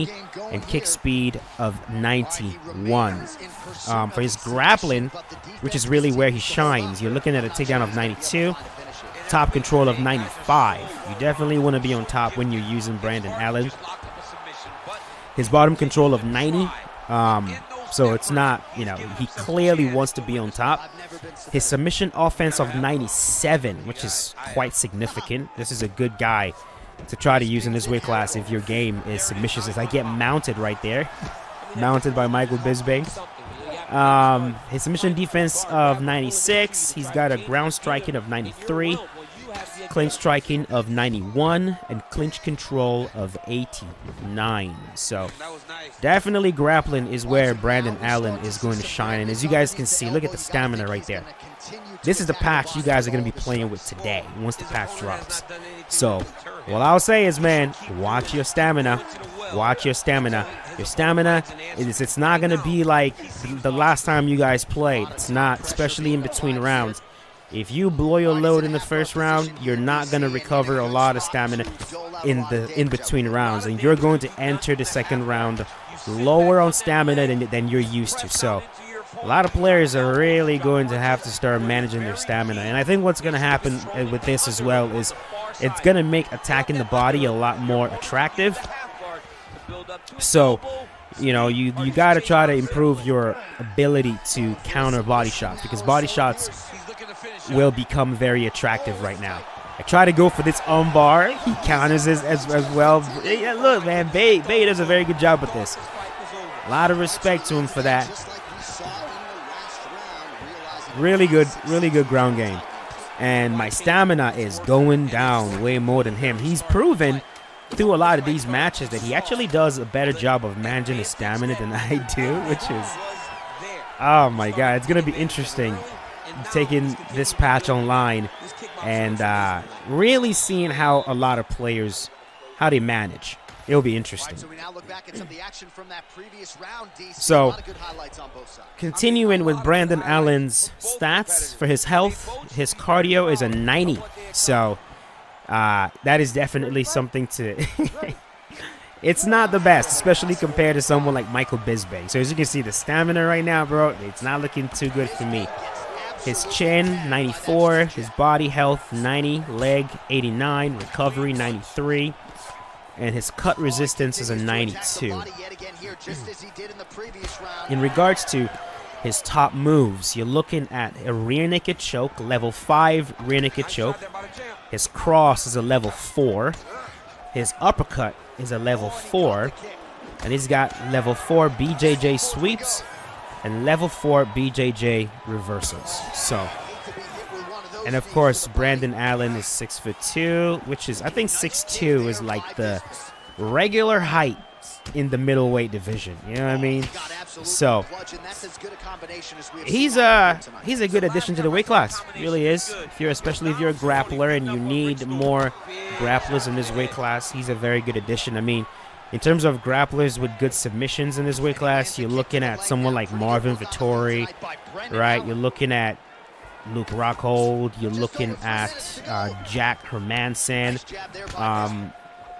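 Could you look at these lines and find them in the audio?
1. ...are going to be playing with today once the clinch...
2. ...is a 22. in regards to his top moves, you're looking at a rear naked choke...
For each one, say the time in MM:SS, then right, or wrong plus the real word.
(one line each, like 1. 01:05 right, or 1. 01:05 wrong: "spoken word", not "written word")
1. 00:53 wrong: "patch", not "clinch"
2. 02:44 wrong: "92", not "22".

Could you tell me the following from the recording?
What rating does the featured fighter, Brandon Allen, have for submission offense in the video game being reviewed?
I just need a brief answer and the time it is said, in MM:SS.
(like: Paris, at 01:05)
97, at 00:21.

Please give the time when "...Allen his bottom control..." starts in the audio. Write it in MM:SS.
00:13.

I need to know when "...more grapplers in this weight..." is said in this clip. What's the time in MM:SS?
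03:25.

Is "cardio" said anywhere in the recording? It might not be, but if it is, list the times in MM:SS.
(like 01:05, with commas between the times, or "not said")
02:22.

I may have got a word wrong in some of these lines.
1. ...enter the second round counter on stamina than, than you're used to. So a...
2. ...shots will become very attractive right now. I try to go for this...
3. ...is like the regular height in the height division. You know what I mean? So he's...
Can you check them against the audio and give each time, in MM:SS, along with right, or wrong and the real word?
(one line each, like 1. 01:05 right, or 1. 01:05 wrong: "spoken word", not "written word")
1. 01:14 wrong: "lower", not "counter"
2. 01:36 right
3. 03:12 wrong: "middleweight", not "height".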